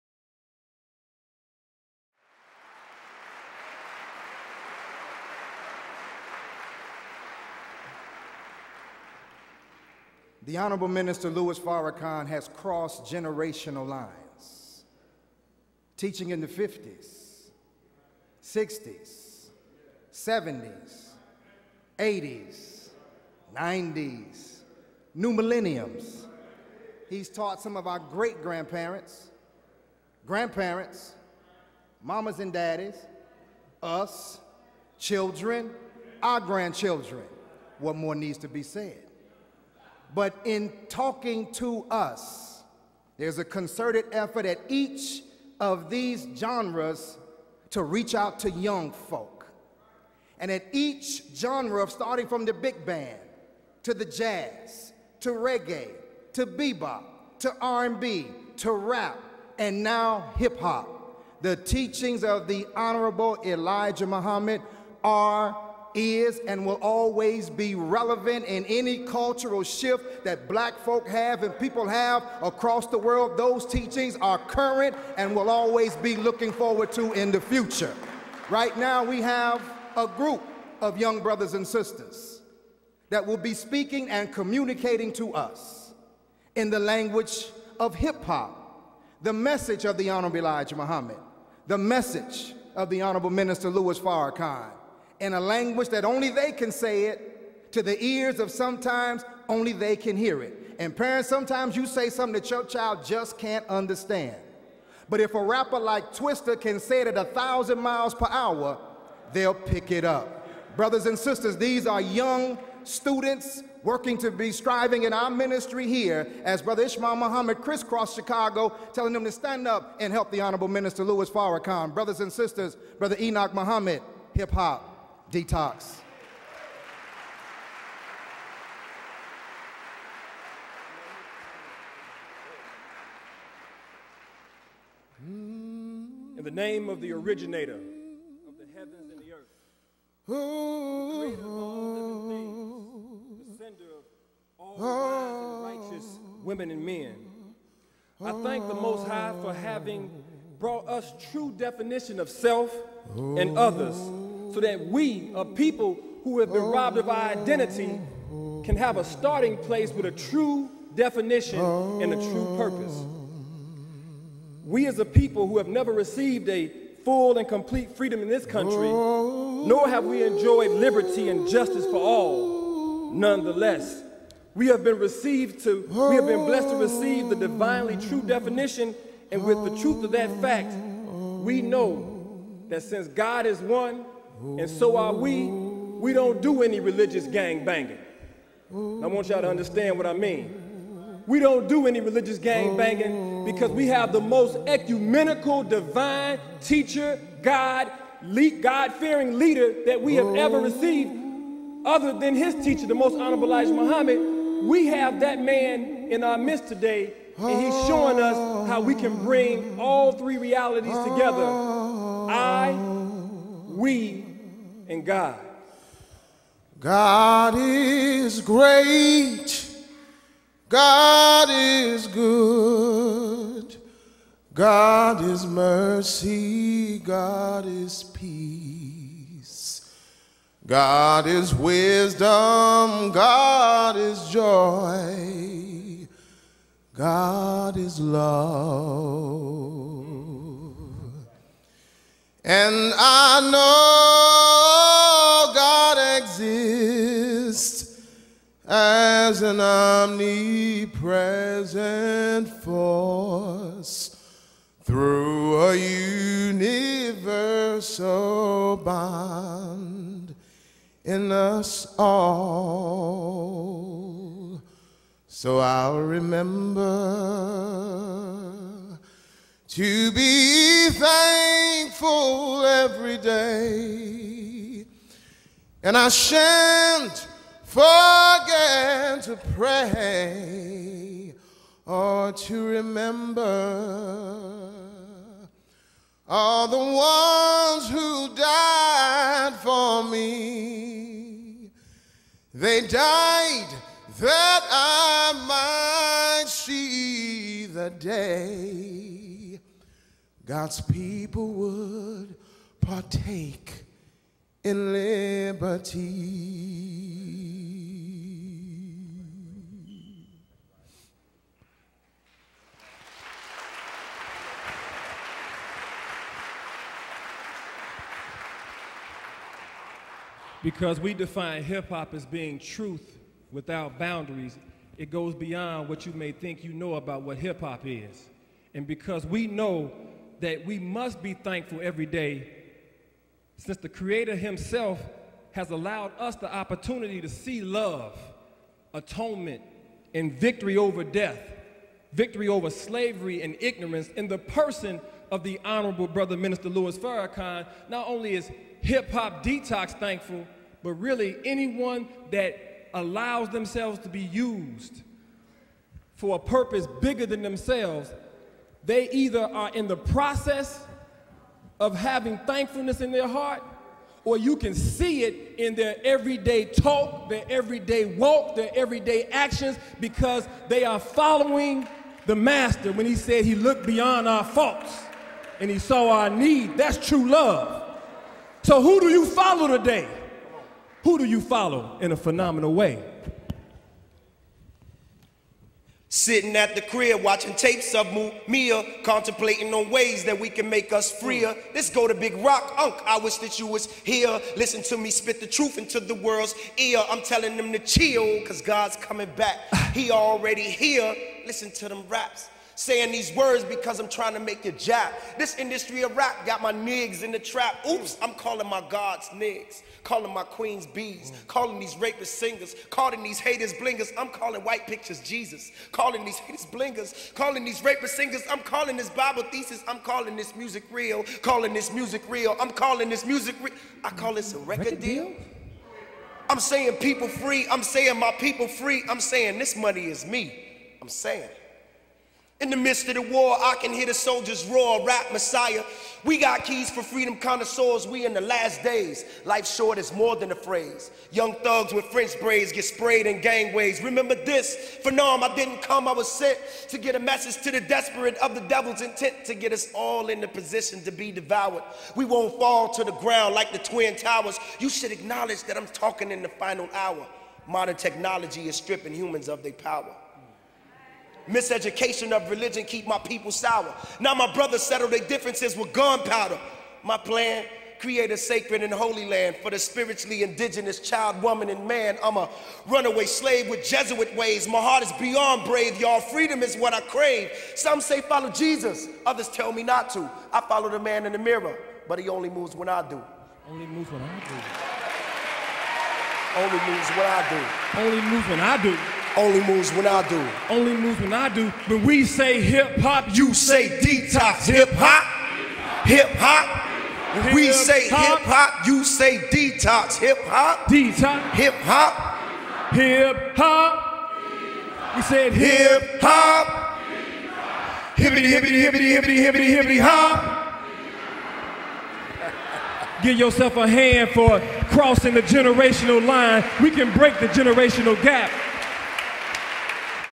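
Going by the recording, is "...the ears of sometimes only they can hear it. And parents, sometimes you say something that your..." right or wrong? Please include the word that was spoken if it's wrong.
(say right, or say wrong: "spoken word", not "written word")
right.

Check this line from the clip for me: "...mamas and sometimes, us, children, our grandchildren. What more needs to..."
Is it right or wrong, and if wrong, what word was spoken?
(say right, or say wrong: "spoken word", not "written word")
wrong: "daddies", not "sometimes".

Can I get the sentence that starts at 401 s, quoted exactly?
Listen to them raps saying these words because I'm trying to make a job.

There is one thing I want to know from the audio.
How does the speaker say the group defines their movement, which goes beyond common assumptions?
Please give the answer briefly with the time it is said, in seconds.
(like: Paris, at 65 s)
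truth without boundaries, at 322 s.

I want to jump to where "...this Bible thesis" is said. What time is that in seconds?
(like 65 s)
418 s.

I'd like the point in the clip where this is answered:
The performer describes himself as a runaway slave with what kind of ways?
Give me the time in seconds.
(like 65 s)
473 s.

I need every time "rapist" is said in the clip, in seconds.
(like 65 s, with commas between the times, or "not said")
411 s, 417 s.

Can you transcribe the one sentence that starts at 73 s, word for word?
Those teachings are current and will always be looking forward to in the future.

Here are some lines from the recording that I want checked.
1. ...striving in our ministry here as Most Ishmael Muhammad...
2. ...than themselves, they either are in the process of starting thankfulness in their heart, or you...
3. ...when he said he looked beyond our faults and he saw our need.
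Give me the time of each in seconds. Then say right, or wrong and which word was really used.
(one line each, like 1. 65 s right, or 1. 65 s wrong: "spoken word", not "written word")
1. 114 s wrong: "Brother", not "Most"
2. 357 s wrong: "having", not "starting"
3. 372 s right.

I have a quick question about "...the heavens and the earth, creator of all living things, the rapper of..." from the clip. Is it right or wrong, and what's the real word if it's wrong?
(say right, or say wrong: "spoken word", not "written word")
wrong: "sender", not "rapper".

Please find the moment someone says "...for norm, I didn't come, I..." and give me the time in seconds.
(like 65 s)
445 s.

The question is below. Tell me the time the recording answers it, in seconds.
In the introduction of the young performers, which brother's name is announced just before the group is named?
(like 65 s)
122 s.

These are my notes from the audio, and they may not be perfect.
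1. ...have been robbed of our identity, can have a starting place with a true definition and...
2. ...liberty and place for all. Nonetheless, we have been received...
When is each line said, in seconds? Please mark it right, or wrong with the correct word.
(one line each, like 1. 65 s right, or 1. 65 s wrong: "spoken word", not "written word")
1. 156 s right
2. 170 s wrong: "justice", not "place".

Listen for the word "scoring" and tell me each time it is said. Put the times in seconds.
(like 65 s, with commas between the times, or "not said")
not said.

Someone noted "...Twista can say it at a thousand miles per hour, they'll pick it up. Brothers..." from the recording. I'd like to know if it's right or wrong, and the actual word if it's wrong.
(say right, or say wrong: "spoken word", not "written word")
right.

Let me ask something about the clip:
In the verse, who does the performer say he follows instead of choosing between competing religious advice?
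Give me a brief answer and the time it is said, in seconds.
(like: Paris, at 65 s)
the man in the mirror, at 480 s.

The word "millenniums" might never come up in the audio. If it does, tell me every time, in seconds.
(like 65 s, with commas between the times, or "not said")
25 s.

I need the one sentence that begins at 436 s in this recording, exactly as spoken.
We got keys for freedom connoisseurs, we in the last days.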